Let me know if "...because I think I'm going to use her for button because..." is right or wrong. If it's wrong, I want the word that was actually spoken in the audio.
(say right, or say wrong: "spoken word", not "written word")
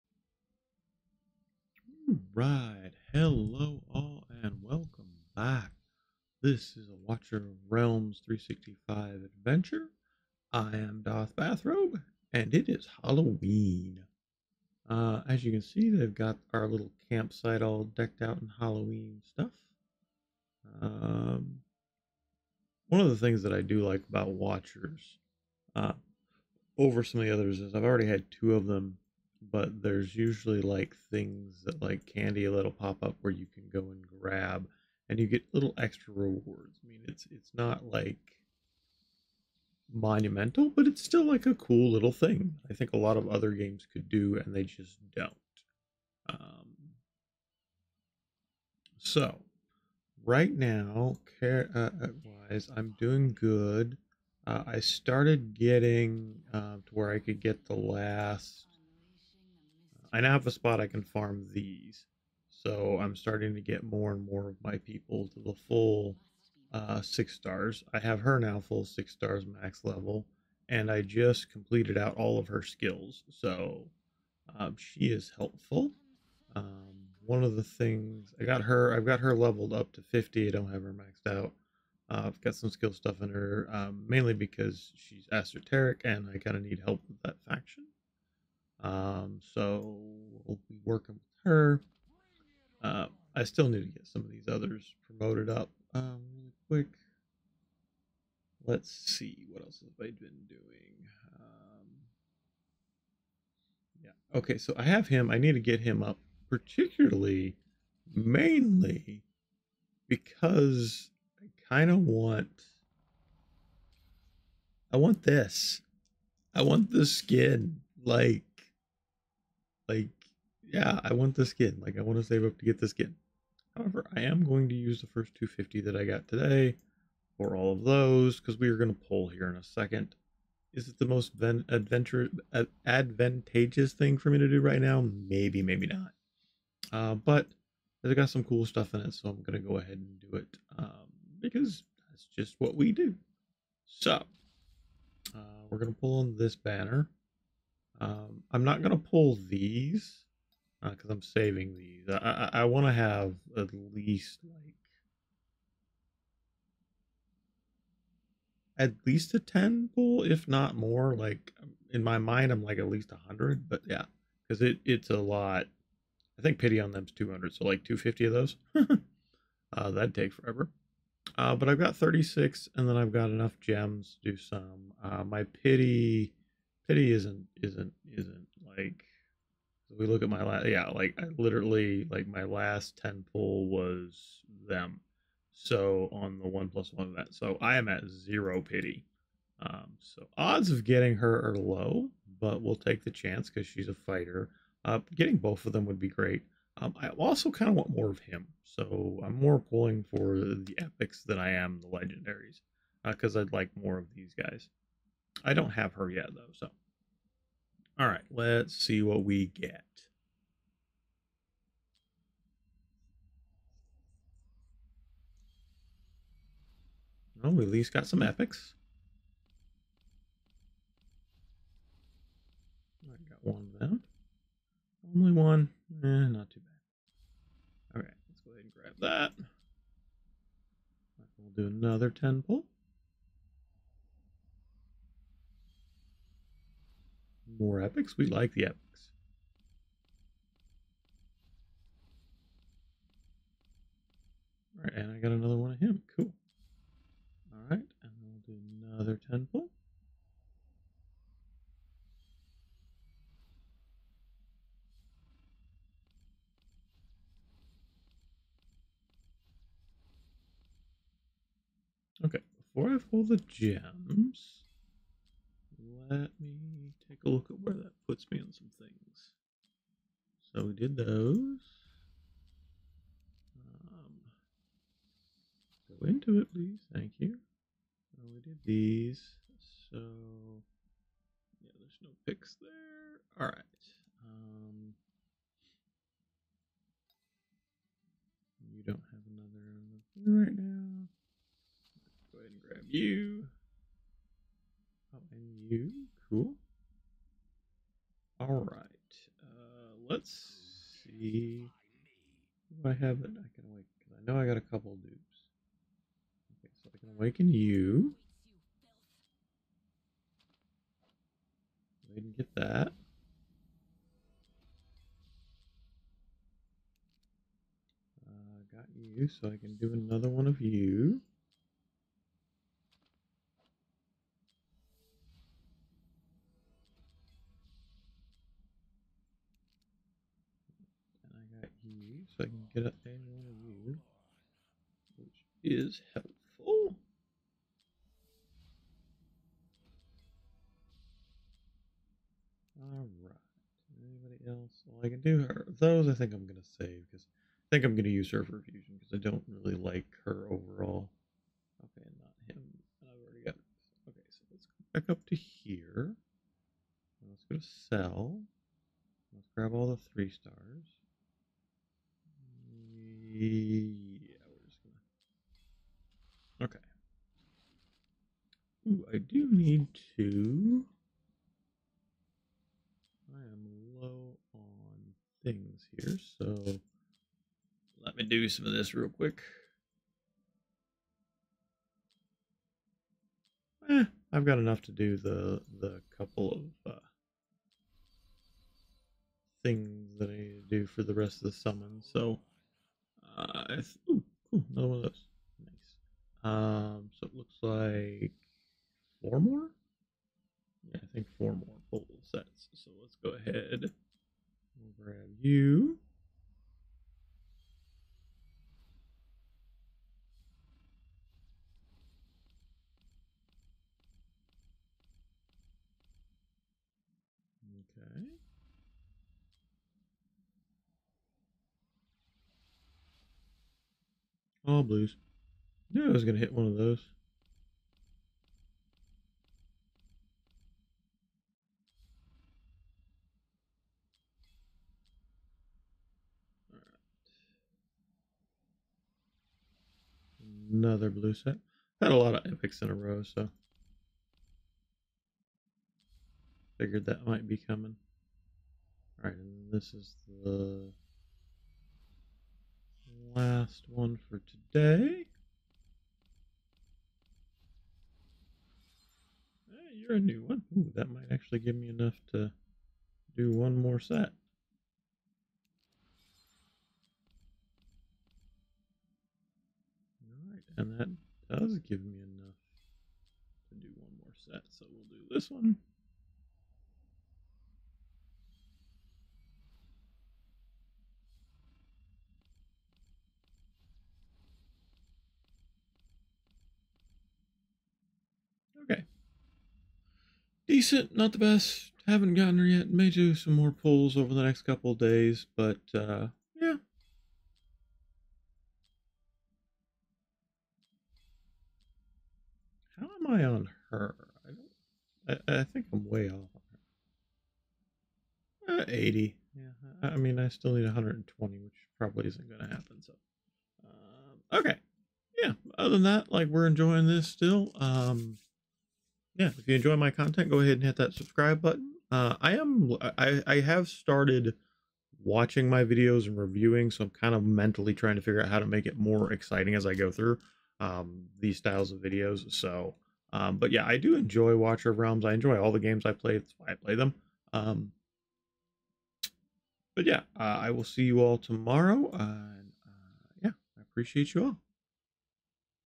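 wrong: "fusion", not "button".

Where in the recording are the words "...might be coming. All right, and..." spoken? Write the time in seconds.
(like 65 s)
447 s.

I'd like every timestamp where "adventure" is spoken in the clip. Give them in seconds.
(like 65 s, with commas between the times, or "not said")
9 s, 131 s.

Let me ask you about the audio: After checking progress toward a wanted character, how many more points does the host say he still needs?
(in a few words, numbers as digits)
120.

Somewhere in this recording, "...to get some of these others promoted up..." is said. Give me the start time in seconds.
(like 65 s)
93 s.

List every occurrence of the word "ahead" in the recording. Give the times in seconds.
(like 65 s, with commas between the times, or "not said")
139 s, 228 s, 292 s, 403 s, 520 s.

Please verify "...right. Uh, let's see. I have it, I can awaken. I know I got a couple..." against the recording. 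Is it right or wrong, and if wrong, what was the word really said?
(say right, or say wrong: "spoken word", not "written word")
right.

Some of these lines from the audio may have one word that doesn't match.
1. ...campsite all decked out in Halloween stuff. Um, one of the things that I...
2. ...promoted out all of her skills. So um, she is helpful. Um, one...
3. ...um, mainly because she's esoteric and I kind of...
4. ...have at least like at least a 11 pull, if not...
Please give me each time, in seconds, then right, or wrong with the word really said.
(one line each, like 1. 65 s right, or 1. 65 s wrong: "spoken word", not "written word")
1. 17 s right
2. 71 s wrong: "completed", not "promoted"
3. 83 s right
4. 152 s wrong: "10", not "11".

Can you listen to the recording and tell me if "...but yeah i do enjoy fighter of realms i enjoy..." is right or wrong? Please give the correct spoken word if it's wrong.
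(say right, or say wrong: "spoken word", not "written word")
wrong: "watcher", not "fighter".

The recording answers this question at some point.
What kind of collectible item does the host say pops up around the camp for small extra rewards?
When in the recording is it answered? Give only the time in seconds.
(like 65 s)
32 s.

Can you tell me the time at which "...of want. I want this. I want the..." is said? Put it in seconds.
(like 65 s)
111 s.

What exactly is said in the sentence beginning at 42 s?
I think a lot of other games could do and they just don't.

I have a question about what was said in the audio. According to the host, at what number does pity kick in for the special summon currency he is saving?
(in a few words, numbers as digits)
200.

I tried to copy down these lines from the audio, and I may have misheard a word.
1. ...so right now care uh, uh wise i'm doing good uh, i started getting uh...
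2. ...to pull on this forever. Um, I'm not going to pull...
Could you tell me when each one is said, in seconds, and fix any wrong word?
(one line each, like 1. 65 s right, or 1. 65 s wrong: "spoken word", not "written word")
1. 48 s right
2. 145 s wrong: "banner", not "forever".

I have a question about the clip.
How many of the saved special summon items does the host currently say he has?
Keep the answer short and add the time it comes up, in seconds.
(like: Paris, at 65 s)
36, at 171 s.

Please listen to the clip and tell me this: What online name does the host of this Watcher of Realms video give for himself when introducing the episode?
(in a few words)
Darth Bathrobe.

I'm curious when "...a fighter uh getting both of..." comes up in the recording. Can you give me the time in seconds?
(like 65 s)
193 s.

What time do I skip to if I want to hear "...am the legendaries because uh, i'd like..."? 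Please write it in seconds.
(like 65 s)
201 s.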